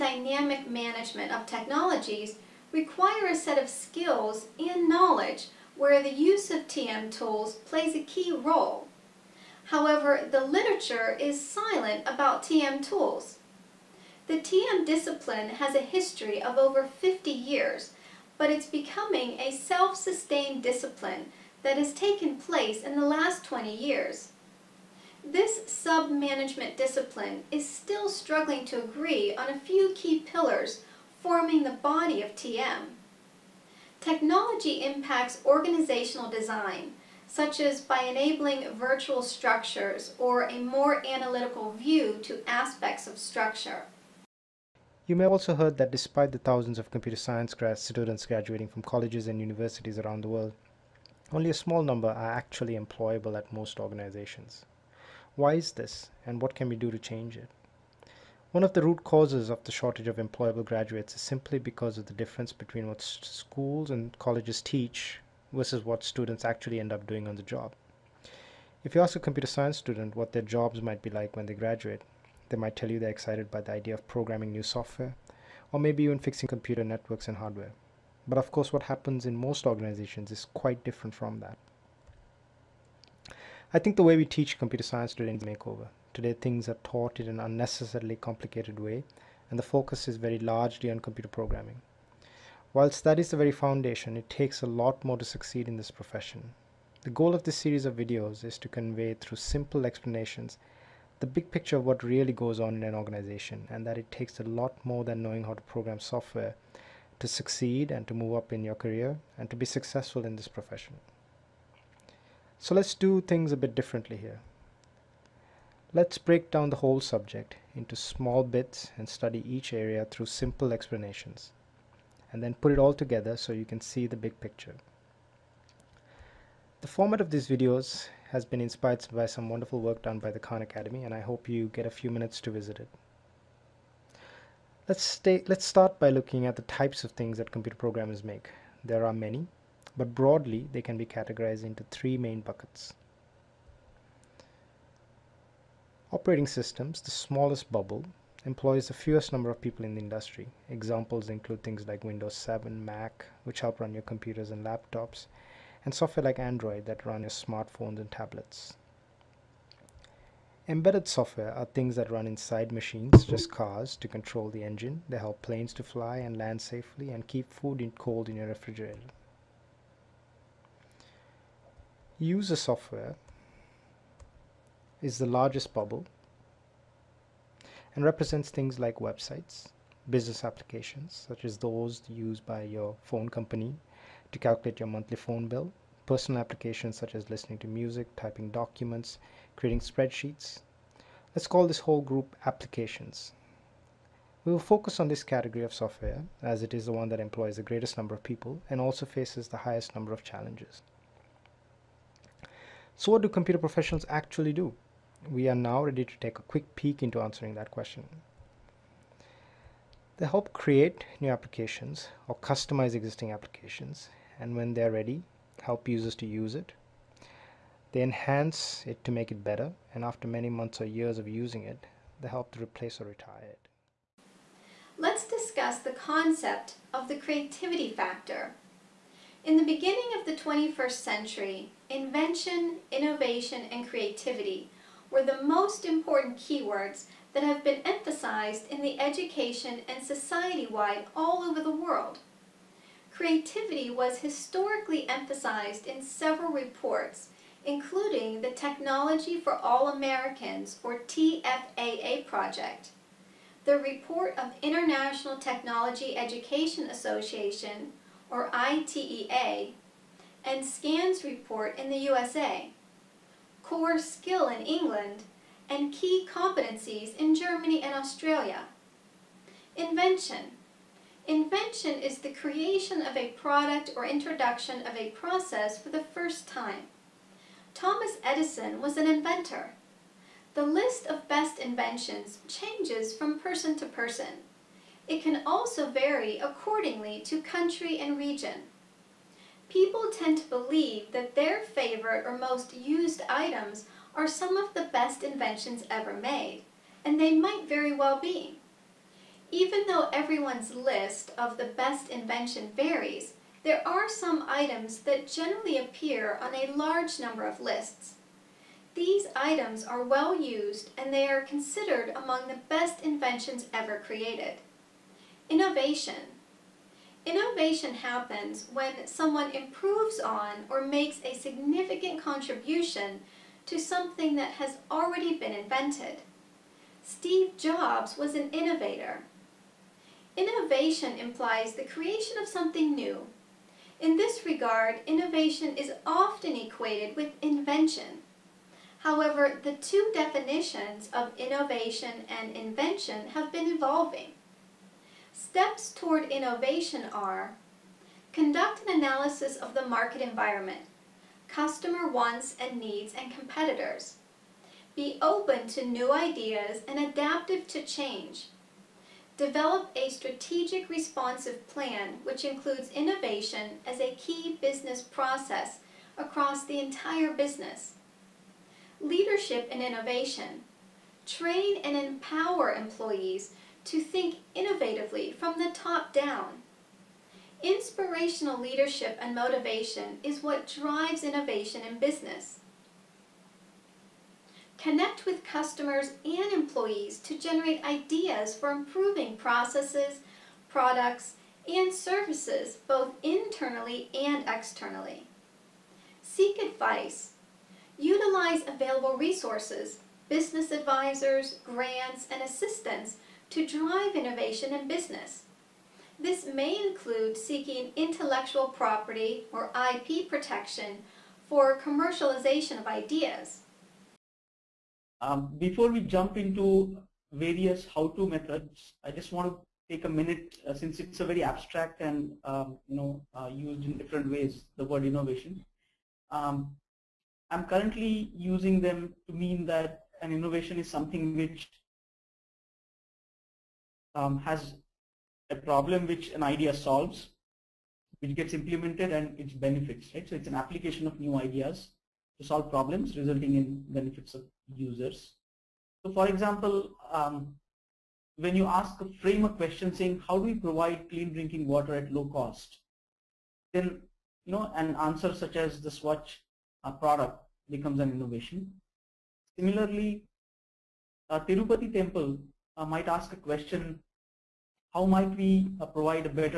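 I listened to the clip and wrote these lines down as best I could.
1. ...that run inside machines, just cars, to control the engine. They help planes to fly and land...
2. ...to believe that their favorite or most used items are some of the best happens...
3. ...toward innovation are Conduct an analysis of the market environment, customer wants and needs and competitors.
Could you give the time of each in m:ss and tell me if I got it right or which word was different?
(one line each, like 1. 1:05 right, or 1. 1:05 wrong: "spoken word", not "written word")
1. 2:41 right
2. 4:50 wrong: "inventions", not "happens"
3. 5:45 right.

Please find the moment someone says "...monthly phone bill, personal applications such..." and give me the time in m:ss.
3:04.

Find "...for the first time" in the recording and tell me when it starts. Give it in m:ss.
4:35.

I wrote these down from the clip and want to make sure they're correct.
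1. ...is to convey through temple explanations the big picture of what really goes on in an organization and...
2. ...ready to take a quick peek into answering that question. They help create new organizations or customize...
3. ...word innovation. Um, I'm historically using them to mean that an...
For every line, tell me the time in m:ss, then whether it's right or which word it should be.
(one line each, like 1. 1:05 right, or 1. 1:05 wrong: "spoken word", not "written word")
1. 1:38 wrong: "simple", not "temple"
2. 3:25 wrong: "applications", not "organizations"
3. 7:04 wrong: "currently", not "historically".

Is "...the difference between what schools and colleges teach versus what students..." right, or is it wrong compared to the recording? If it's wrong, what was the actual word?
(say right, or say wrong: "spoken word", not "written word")
right.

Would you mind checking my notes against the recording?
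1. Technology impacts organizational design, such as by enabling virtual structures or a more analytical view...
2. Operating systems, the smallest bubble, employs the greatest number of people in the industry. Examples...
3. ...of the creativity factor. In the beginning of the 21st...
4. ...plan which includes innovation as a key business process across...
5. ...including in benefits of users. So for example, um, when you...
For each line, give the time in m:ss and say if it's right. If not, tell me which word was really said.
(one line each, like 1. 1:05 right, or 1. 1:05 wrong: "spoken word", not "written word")
1. 0:34 right
2. 2:26 wrong: "fewest", not "greatest"
3. 3:46 right
4. 6:01 right
5. 7:23 wrong: "resulting", not "including".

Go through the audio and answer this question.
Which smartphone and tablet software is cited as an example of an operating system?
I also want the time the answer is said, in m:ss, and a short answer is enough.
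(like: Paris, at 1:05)
Android, at 2:36.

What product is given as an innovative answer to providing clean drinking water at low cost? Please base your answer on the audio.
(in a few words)
Swach.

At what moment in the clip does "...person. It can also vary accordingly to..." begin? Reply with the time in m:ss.
4:43.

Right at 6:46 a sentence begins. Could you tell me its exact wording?
This may include seeking intellectual property or IP protection for commercialization of ideas.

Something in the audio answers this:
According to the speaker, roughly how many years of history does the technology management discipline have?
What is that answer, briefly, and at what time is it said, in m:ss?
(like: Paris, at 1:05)
over 50 years, at 0:16.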